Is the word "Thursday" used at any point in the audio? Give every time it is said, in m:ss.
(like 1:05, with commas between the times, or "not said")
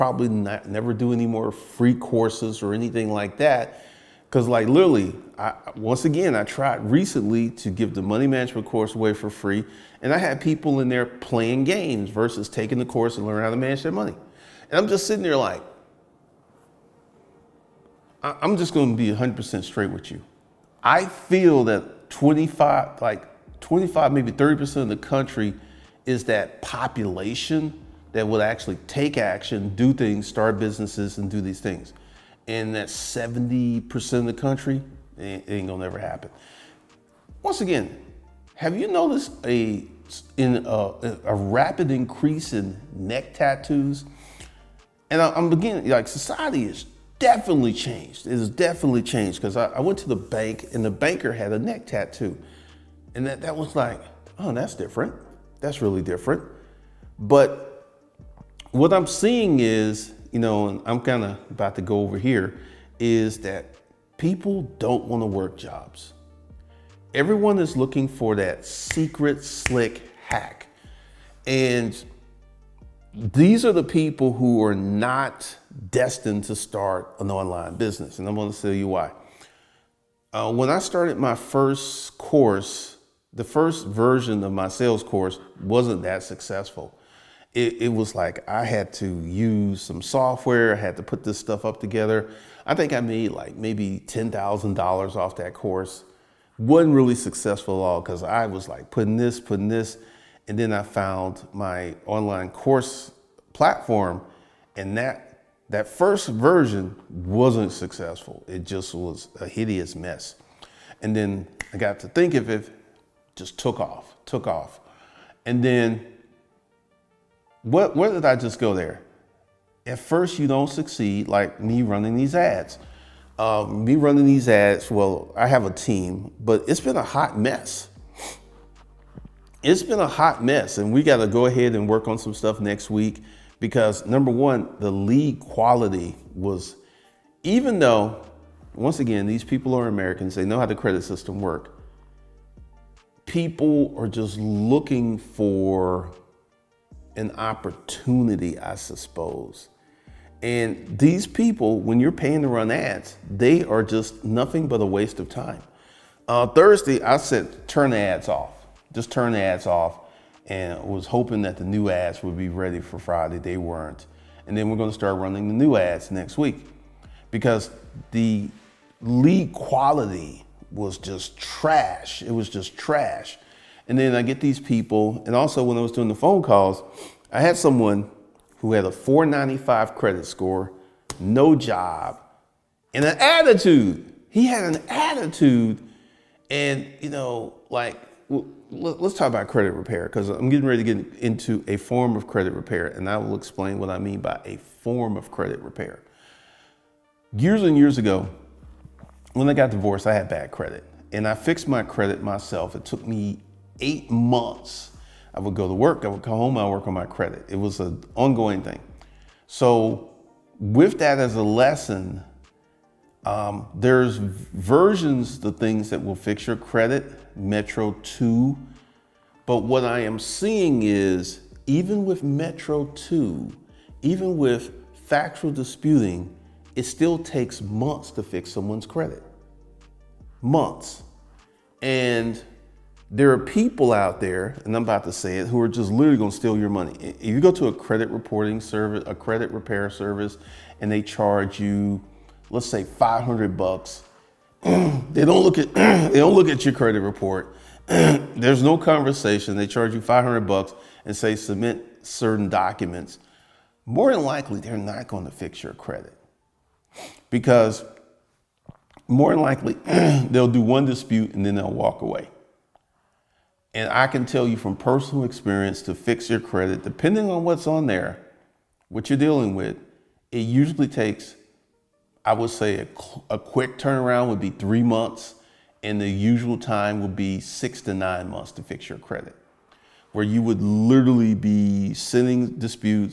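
2:36.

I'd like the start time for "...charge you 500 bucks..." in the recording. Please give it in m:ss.
4:09.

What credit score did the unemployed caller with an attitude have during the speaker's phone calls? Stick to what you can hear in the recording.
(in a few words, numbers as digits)
495.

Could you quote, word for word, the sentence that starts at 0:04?
Cause like literally, I, once again, I tried recently to give the money management course away for free.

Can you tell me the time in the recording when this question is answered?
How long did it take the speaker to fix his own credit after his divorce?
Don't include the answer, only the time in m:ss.
3:23.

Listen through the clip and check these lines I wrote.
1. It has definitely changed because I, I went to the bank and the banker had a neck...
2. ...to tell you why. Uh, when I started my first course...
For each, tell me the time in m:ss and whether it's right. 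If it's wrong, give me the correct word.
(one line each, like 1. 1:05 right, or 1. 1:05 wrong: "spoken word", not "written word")
1. 0:48 right
2. 1:18 right.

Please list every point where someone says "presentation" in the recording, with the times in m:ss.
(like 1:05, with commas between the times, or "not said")
not said.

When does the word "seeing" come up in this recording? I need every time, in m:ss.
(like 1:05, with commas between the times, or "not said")
0:59, 3:40.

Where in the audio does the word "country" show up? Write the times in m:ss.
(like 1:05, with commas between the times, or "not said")
0:24, 0:34.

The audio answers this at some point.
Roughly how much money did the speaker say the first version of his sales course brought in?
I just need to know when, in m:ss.
1:34.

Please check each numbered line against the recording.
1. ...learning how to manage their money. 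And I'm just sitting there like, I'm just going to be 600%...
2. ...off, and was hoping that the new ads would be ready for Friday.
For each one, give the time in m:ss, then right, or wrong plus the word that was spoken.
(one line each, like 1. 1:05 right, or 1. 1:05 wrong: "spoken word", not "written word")
1. 0:13 wrong: "100", not "600"
2. 2:39 right.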